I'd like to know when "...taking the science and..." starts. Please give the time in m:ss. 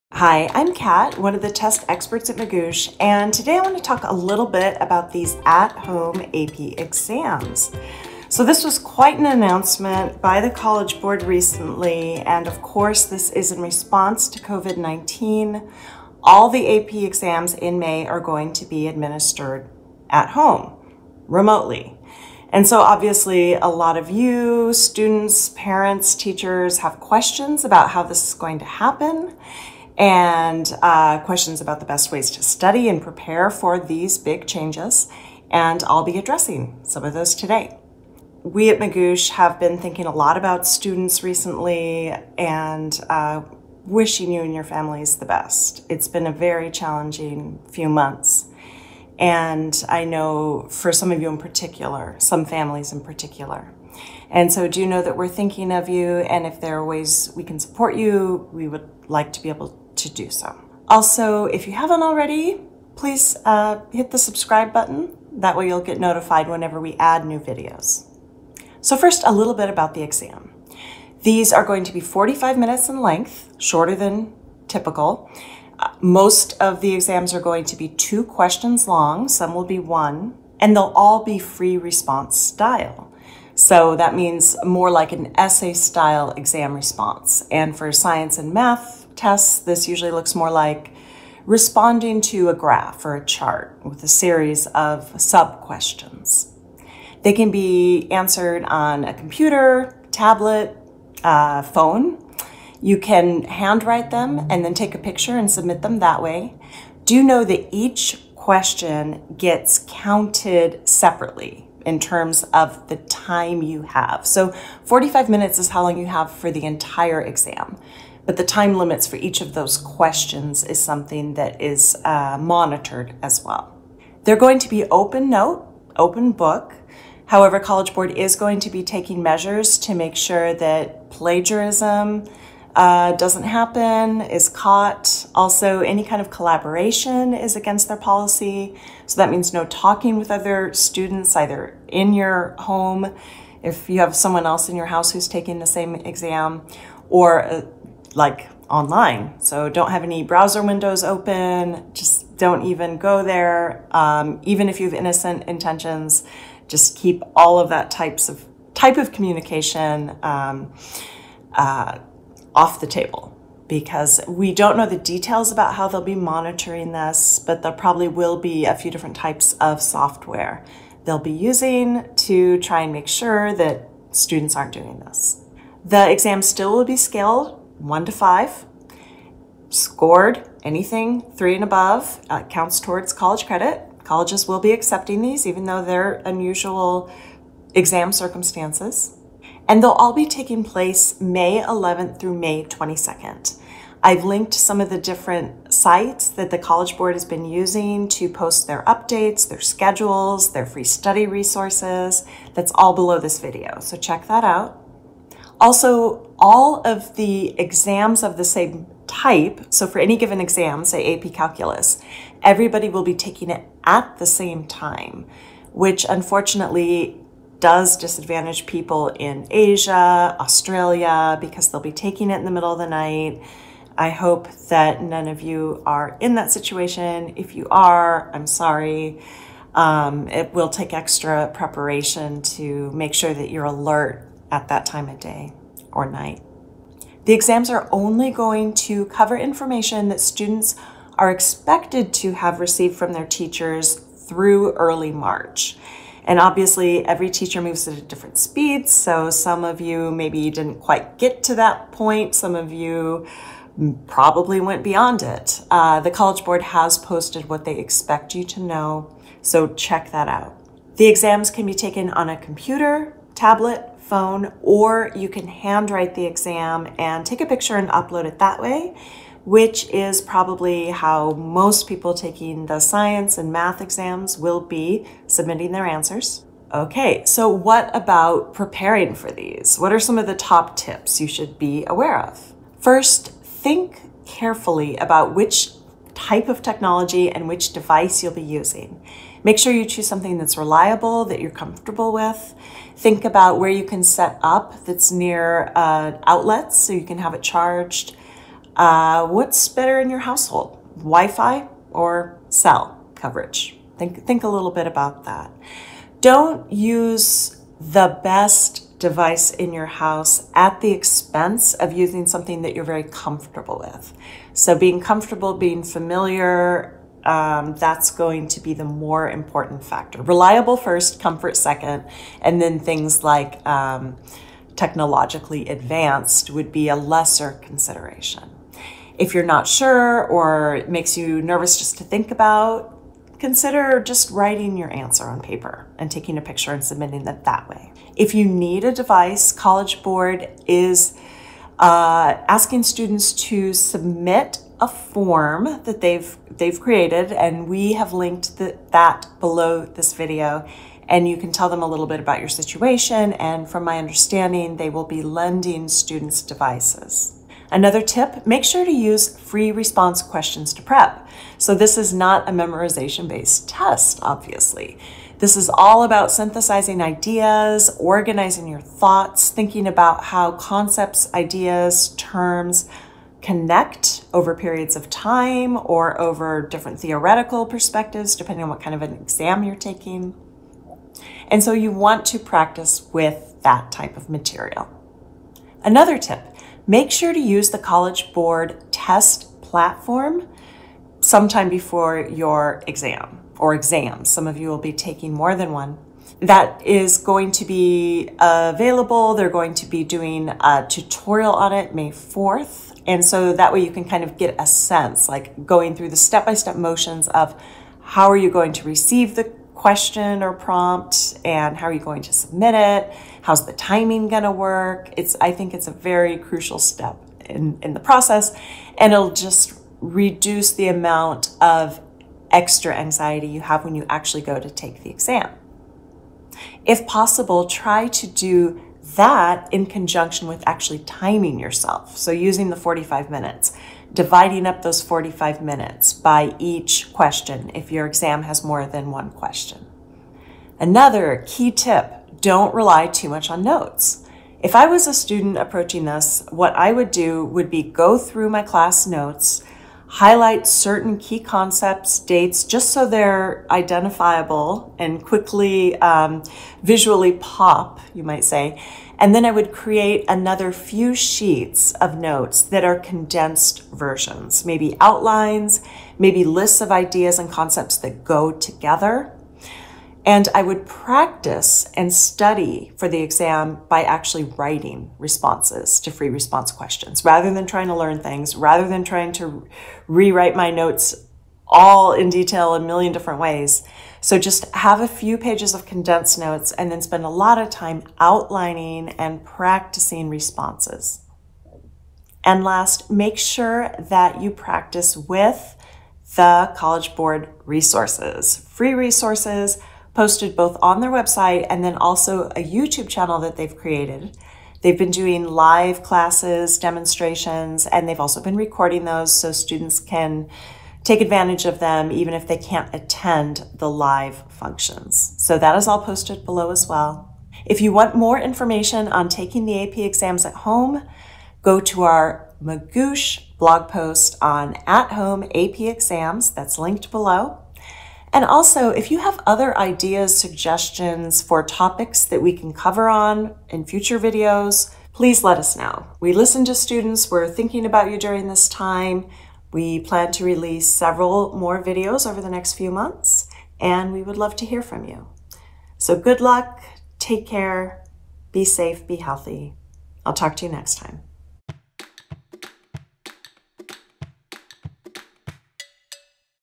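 4:32.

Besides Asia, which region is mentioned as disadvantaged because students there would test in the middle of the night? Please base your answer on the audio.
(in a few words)
Australia.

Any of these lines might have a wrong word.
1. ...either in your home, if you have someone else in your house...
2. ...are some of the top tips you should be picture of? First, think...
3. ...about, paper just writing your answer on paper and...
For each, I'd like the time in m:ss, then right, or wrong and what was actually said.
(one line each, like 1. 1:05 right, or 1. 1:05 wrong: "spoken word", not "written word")
1. 2:21 right
2. 4:39 wrong: "aware", not "picture"
3. 5:32 wrong: "consider", not "paper".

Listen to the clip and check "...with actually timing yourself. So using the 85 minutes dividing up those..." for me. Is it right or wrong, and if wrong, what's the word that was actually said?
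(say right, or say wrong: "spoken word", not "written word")
wrong: "45", not "85".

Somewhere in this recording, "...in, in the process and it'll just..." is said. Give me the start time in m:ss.
6:57.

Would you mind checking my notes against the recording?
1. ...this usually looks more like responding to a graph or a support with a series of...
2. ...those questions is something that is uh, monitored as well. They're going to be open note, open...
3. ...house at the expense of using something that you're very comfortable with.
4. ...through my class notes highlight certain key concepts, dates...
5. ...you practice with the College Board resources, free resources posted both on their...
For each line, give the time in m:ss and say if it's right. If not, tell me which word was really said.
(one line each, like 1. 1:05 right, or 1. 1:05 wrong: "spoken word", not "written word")
1. 1:29 wrong: "chart", not "support"
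2. 1:59 right
3. 5:09 right
4. 7:28 right
5. 8:14 right.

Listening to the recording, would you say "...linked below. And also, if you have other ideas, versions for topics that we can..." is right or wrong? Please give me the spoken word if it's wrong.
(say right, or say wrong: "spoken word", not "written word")
wrong: "suggestions", not "versions".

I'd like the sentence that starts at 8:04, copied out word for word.
So just have a few pages of condensed notes and then spend a lot of time outlining and practicing responses.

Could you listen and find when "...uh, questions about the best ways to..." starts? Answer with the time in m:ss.
0:30.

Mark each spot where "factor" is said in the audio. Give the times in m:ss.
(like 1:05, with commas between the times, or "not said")
5:19.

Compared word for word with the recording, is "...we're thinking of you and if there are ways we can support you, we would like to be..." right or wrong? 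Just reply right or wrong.
right.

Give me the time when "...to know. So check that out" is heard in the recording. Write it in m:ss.
4:18.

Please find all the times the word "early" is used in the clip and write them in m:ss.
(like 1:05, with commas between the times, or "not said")
4:04.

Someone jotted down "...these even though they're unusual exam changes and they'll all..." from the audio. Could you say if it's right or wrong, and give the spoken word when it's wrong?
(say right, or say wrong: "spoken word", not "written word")
wrong: "circumstances", not "changes".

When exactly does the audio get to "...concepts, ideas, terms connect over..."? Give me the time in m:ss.
6:10.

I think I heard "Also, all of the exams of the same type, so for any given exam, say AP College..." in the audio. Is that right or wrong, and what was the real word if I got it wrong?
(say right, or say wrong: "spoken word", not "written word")
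wrong: "Calculus", not "College".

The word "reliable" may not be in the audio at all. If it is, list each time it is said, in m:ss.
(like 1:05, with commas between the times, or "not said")
4:50, 5:20.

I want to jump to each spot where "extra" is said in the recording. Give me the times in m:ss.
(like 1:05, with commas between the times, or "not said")
3:50, 7:02.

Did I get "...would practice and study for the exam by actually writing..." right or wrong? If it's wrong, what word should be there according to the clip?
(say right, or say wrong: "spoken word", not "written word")
right.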